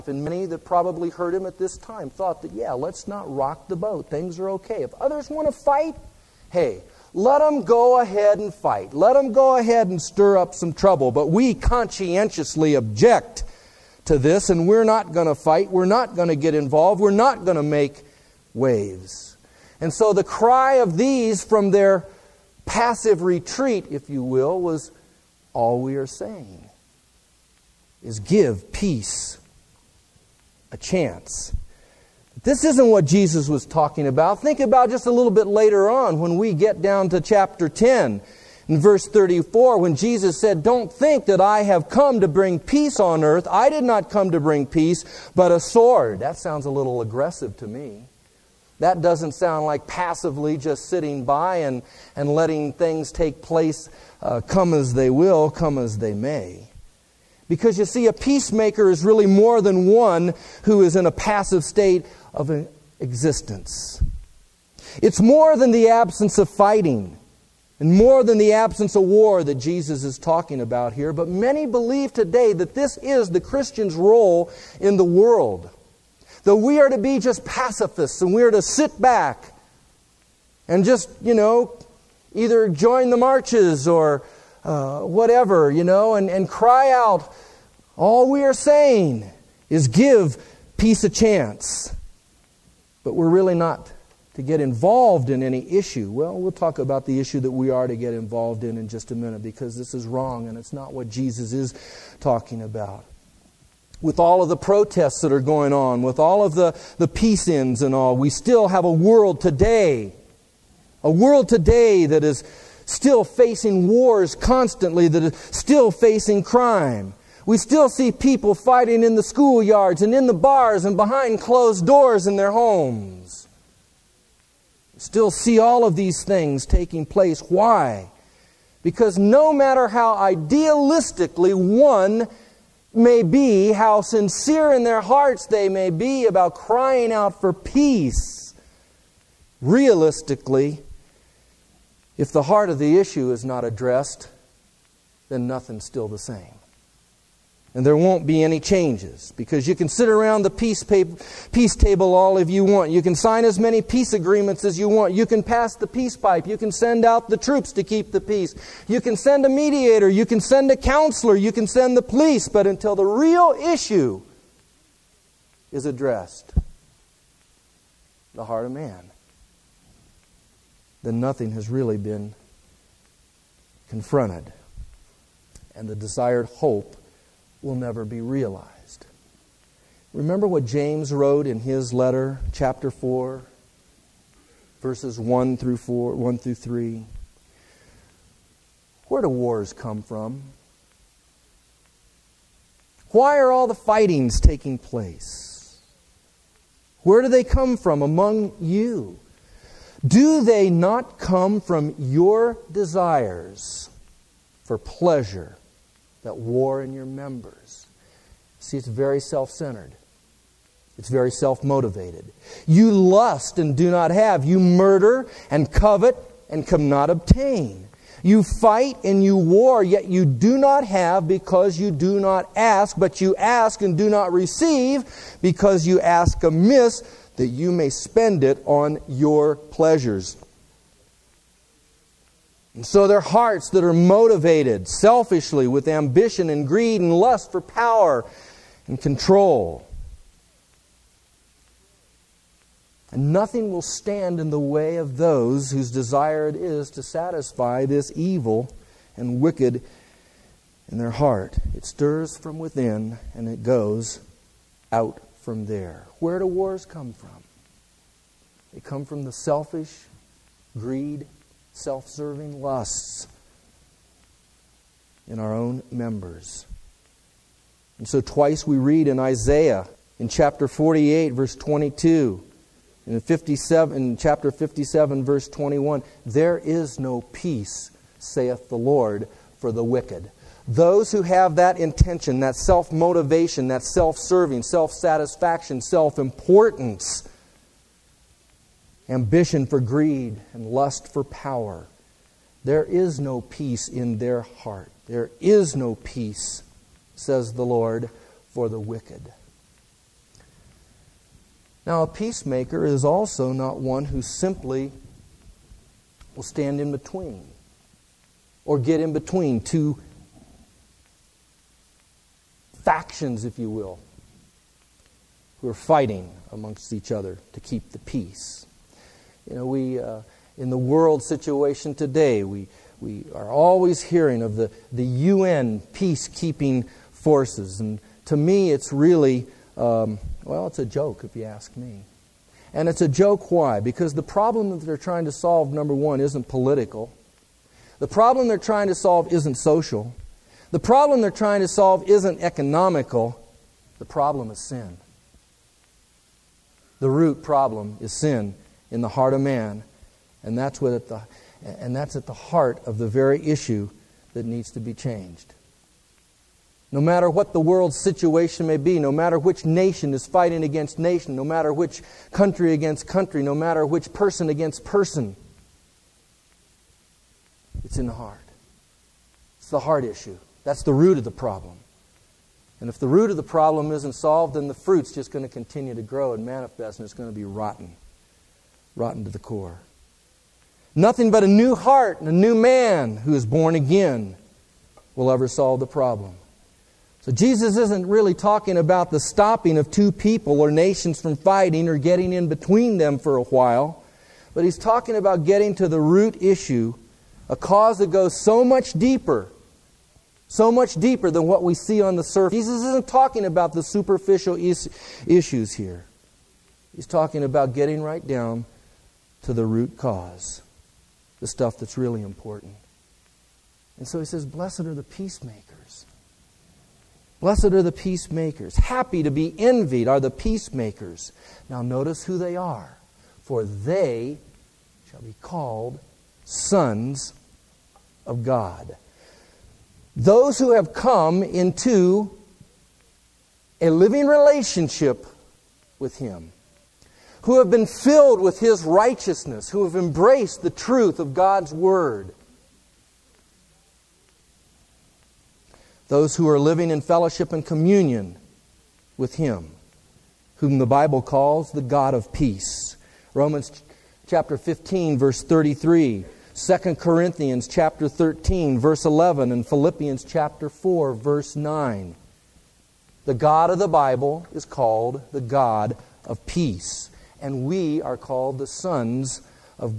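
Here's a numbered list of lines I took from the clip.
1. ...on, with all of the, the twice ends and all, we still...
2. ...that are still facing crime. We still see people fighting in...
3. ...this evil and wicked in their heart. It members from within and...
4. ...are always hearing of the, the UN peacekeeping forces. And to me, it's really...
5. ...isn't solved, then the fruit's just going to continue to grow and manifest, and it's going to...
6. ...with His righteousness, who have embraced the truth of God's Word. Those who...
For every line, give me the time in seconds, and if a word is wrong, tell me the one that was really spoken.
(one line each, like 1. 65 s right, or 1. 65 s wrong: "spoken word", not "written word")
1. 105 s wrong: "peace", not "twice"
2. 115 s right
3. 247 s wrong: "stirs", not "members"
4. 323 s right
5. 373 s right
6. 438 s right.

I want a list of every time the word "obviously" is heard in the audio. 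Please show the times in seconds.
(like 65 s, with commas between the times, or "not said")
not said.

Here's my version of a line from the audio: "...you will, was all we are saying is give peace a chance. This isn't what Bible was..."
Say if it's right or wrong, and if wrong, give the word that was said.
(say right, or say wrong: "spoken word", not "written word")
wrong: "Jesus", not "Bible".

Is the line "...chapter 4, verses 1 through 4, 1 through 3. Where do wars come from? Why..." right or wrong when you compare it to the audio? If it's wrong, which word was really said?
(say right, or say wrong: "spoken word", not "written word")
right.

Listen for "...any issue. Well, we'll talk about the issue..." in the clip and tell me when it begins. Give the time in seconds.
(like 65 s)
95 s.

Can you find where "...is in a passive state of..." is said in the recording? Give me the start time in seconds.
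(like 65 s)
60 s.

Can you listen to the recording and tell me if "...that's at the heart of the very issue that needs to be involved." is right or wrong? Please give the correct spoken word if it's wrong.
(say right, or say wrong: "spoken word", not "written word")
wrong: "changed", not "involved".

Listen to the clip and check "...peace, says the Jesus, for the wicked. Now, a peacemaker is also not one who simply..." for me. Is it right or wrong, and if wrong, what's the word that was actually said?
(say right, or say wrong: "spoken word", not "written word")
wrong: "Lord", not "Jesus".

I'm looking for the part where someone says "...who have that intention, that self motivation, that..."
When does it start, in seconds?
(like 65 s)
281 s.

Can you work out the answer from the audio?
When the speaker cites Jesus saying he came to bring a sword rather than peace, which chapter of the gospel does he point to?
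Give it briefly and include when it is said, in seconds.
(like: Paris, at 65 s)
Chapter 10, at 37 s.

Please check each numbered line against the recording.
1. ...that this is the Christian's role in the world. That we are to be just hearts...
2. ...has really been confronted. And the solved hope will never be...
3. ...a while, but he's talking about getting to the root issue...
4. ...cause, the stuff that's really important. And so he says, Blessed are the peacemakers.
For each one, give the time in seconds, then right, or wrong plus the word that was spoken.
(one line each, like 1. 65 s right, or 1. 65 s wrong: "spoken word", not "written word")
1. 72 s wrong: "pacifists", not "hearts"
2. 171 s wrong: "desired", not "solved"
3. 393 s right
4. 409 s right.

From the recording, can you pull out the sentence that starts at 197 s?
Where do they come from among you?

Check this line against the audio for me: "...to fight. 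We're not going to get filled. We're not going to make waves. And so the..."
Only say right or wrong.
wrong.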